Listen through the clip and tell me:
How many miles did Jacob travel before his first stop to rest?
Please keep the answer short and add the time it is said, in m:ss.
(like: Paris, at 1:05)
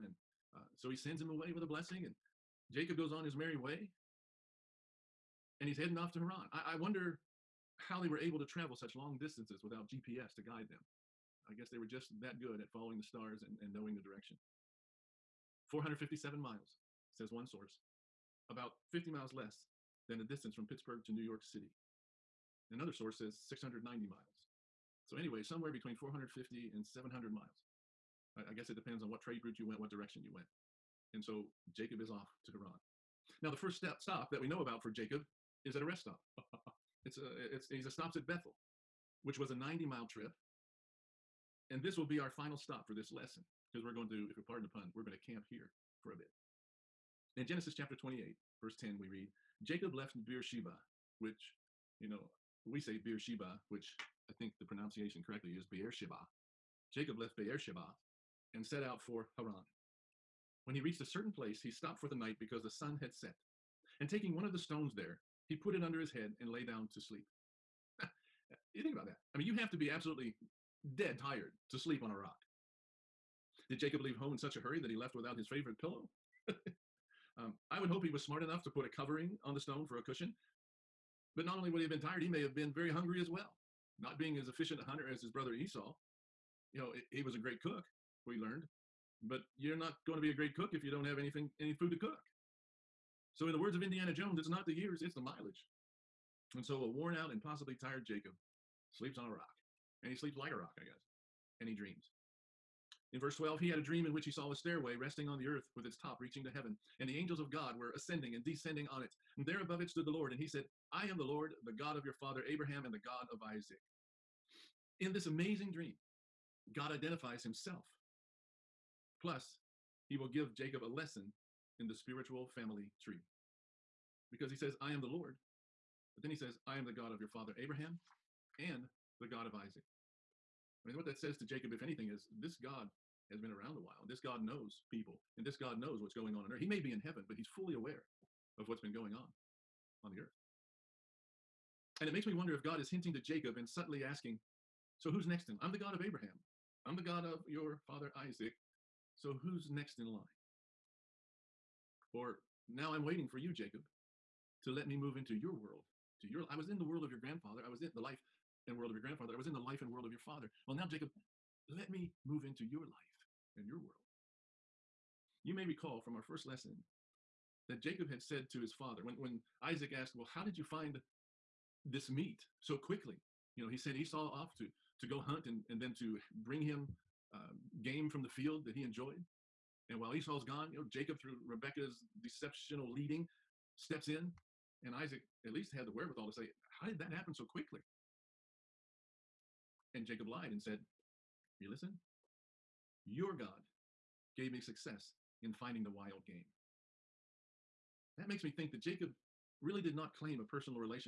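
90, at 0:39.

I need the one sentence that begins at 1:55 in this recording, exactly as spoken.
In this amazing dream, God identifies himself.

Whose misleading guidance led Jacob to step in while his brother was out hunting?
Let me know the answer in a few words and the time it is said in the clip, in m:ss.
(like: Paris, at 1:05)
Rebecca, at 3:01.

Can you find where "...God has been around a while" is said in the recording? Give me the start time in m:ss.
2:12.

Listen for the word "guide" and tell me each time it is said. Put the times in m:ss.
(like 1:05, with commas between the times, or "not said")
0:10.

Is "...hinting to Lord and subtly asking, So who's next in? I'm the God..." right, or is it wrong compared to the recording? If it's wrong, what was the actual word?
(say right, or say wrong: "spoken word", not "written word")
wrong: "Jacob", not "Lord".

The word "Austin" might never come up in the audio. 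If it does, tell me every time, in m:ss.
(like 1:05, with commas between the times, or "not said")
not said.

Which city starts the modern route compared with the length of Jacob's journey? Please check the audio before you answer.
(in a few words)
Pittsburgh.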